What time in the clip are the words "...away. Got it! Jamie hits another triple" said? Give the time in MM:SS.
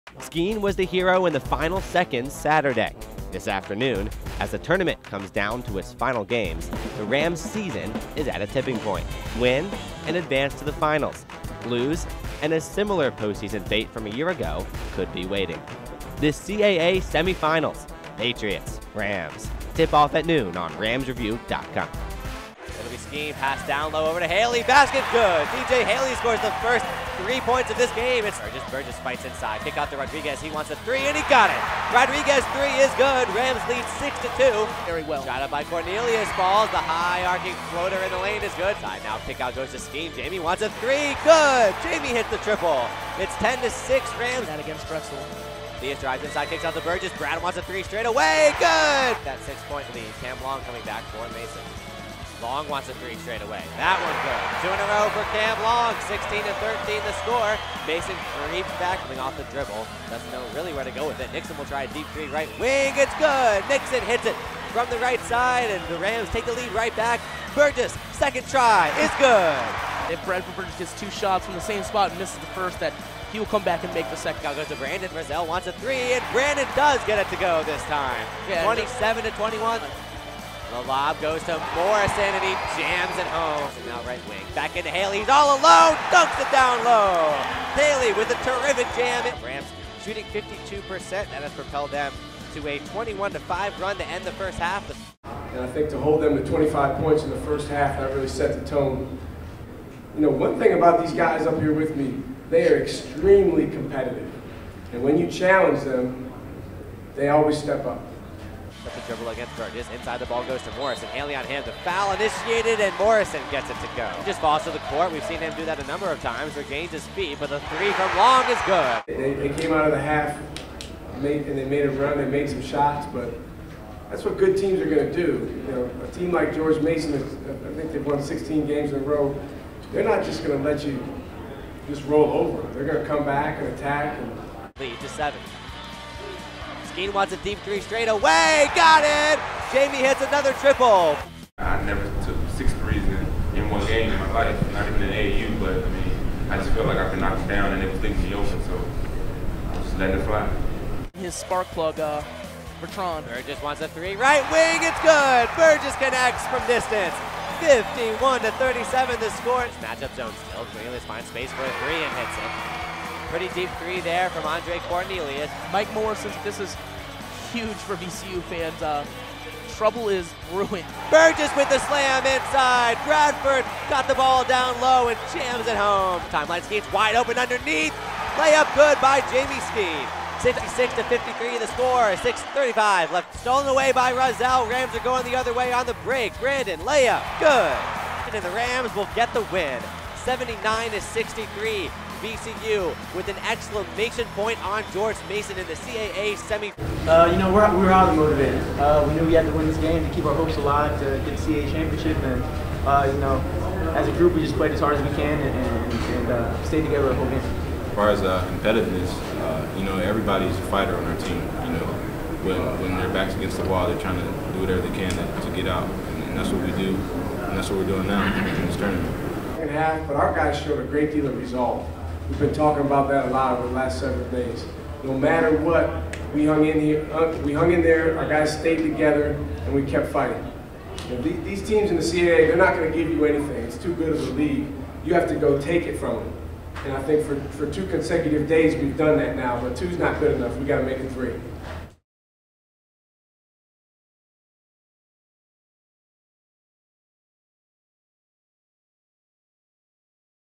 02:18.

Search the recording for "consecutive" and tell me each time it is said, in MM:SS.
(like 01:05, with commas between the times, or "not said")
03:57.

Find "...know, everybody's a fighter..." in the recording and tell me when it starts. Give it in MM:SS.
03:29.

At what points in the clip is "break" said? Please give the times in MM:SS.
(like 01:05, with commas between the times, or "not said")
03:06.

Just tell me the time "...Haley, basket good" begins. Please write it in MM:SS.
00:24.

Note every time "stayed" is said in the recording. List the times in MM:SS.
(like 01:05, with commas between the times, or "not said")
03:26, 03:48.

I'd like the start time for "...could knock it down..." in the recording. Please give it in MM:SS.
02:27.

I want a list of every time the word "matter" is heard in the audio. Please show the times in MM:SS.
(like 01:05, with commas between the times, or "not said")
03:45.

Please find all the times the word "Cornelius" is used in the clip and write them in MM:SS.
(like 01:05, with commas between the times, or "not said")
00:35, 02:44.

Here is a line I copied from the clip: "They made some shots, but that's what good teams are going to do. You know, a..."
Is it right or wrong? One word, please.
right.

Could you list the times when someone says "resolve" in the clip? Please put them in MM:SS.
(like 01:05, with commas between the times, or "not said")
03:41.